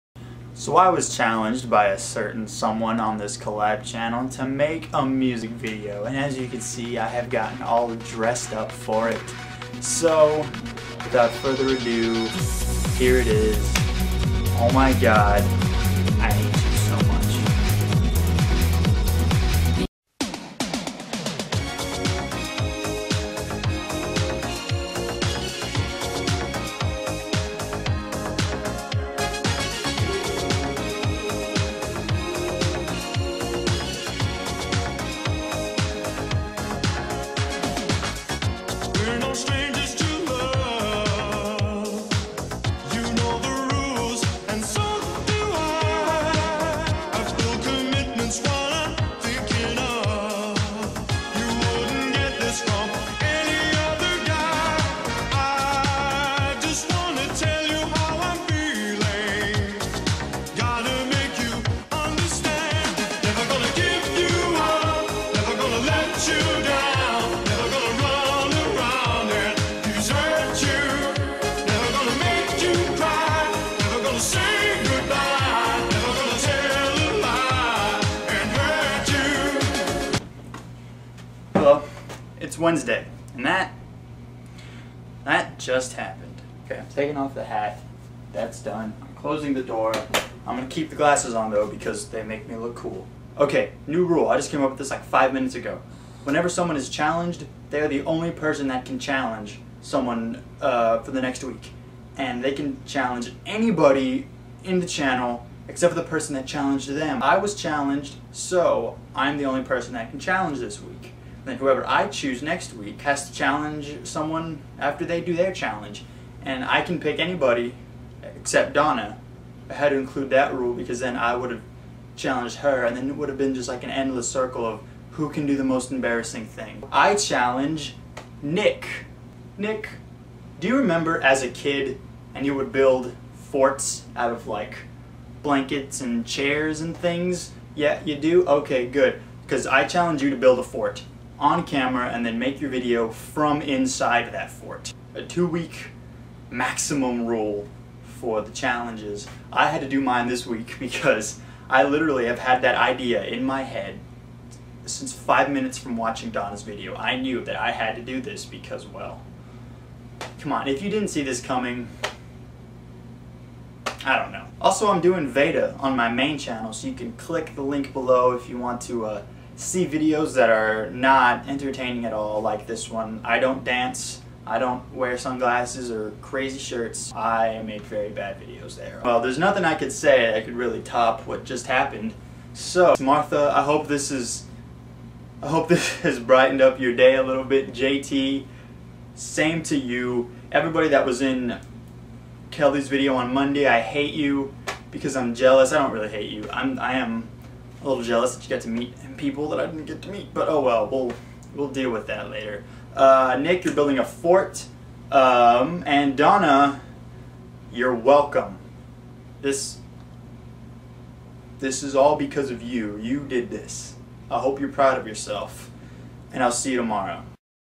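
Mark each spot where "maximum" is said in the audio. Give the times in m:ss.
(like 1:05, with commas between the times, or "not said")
2:26.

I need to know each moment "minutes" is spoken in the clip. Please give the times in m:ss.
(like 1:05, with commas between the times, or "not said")
1:35, 2:35.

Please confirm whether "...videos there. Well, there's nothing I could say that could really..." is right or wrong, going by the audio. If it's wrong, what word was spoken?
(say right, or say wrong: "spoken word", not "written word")
right.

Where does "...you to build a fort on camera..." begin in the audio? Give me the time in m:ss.
2:20.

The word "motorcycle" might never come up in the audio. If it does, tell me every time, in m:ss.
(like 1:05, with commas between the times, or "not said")
not said.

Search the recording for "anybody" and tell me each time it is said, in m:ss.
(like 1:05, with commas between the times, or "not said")
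1:43, 1:57.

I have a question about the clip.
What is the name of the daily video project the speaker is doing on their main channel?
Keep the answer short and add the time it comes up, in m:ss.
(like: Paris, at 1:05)
Veda, at 2:45.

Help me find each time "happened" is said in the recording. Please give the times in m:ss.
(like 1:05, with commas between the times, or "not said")
1:25, 3:01.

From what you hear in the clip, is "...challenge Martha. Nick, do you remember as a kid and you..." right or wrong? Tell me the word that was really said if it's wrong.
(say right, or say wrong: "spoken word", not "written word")
wrong: "Nick", not "Martha".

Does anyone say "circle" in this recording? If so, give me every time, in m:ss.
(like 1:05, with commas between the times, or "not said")
2:04.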